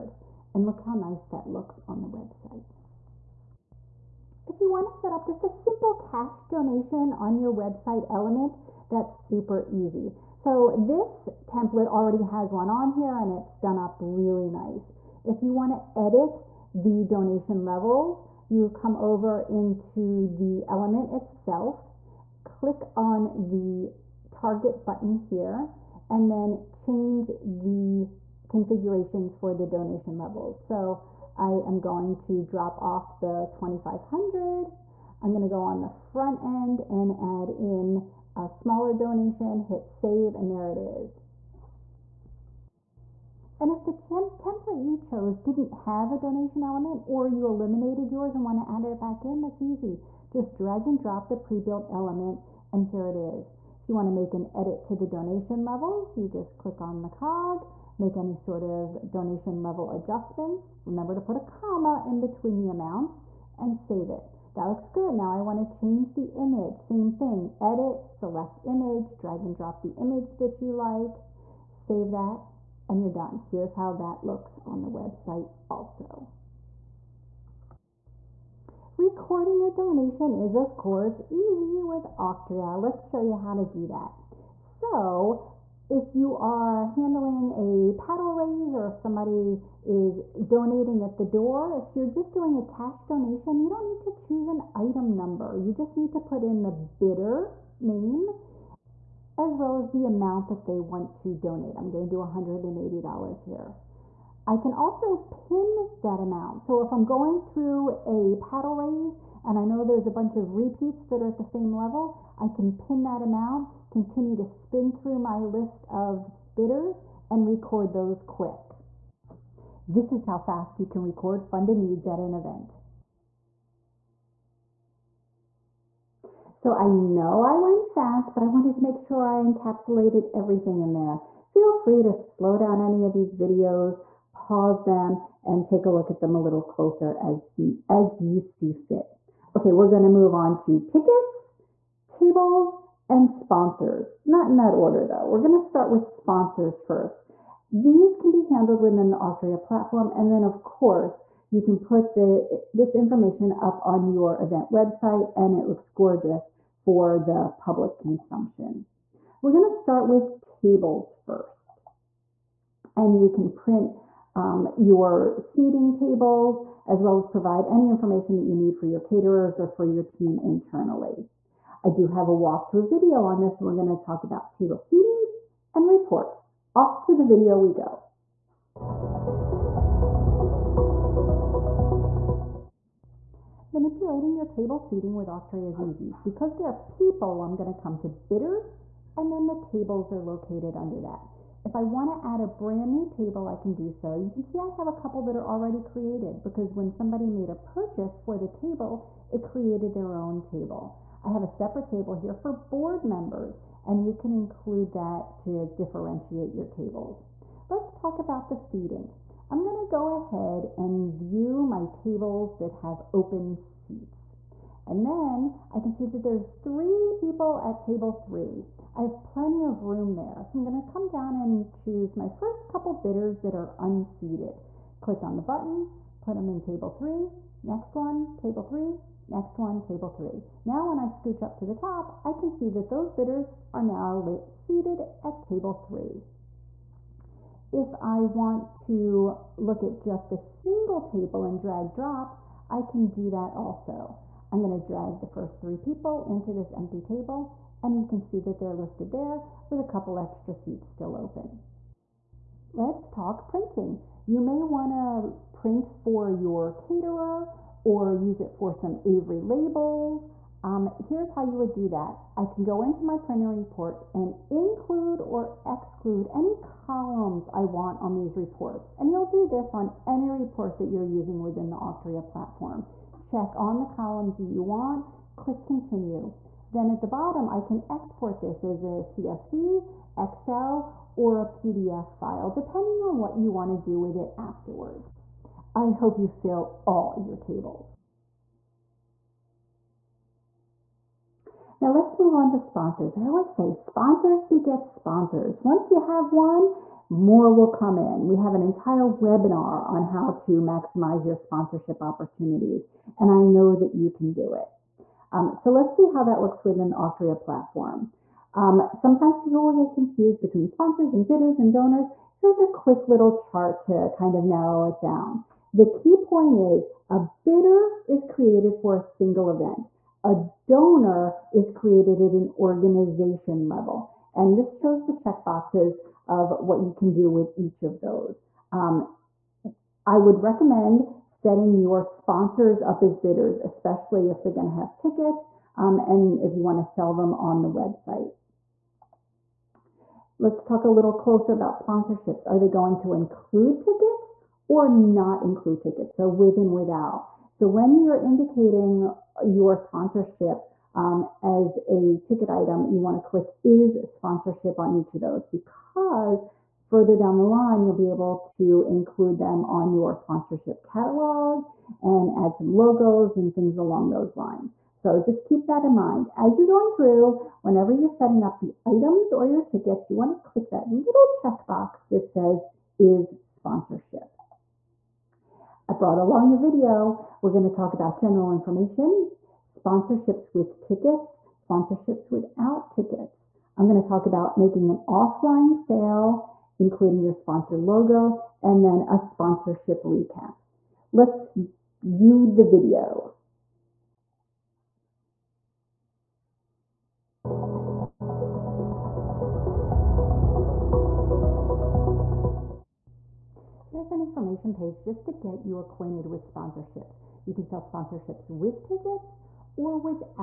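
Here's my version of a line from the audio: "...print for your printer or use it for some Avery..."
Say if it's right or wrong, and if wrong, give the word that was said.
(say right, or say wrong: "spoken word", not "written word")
wrong: "caterer", not "printer".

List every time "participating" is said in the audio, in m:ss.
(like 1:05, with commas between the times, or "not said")
not said.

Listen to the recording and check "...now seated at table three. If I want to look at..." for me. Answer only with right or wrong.
right.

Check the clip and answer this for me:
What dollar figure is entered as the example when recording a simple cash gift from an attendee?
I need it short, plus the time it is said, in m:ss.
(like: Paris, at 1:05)
$180, at 1:42.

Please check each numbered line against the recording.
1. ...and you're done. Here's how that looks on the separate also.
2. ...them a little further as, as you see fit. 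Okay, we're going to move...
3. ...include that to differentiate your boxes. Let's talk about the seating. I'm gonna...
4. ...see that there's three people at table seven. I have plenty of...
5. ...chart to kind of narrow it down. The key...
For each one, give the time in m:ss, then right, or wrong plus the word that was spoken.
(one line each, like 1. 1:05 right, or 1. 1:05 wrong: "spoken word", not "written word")
1. 1:12 wrong: "website", not "separate"
2. 2:16 wrong: "closer", not "further"
3. 3:24 wrong: "tables", not "boxes"
4. 3:35 wrong: "three", not "seven"
5. 5:13 right.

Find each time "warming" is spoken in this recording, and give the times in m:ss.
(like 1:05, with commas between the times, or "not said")
not said.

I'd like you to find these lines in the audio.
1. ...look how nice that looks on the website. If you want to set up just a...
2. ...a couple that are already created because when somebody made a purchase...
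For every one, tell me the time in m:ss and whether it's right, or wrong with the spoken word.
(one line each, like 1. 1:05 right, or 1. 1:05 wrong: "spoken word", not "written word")
1. 0:00 right
2. 3:14 right.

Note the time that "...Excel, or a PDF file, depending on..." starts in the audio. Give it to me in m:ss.
4:40.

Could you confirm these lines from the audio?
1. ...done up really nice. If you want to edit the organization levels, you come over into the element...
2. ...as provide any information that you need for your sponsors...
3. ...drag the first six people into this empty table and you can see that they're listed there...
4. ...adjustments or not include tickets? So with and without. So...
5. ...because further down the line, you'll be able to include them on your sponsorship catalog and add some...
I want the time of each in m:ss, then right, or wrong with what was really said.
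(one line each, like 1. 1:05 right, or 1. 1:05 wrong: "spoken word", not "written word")
1. 0:13 wrong: "donation", not "organization"
2. 2:47 wrong: "caterers", not "sponsors"
3. 4:04 wrong: "three", not "six"
4. 5:43 wrong: "tickets", not "adjustments"
5. 5:55 right.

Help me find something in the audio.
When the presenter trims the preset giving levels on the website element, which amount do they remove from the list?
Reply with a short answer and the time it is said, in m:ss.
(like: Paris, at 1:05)
2500, at 0:33.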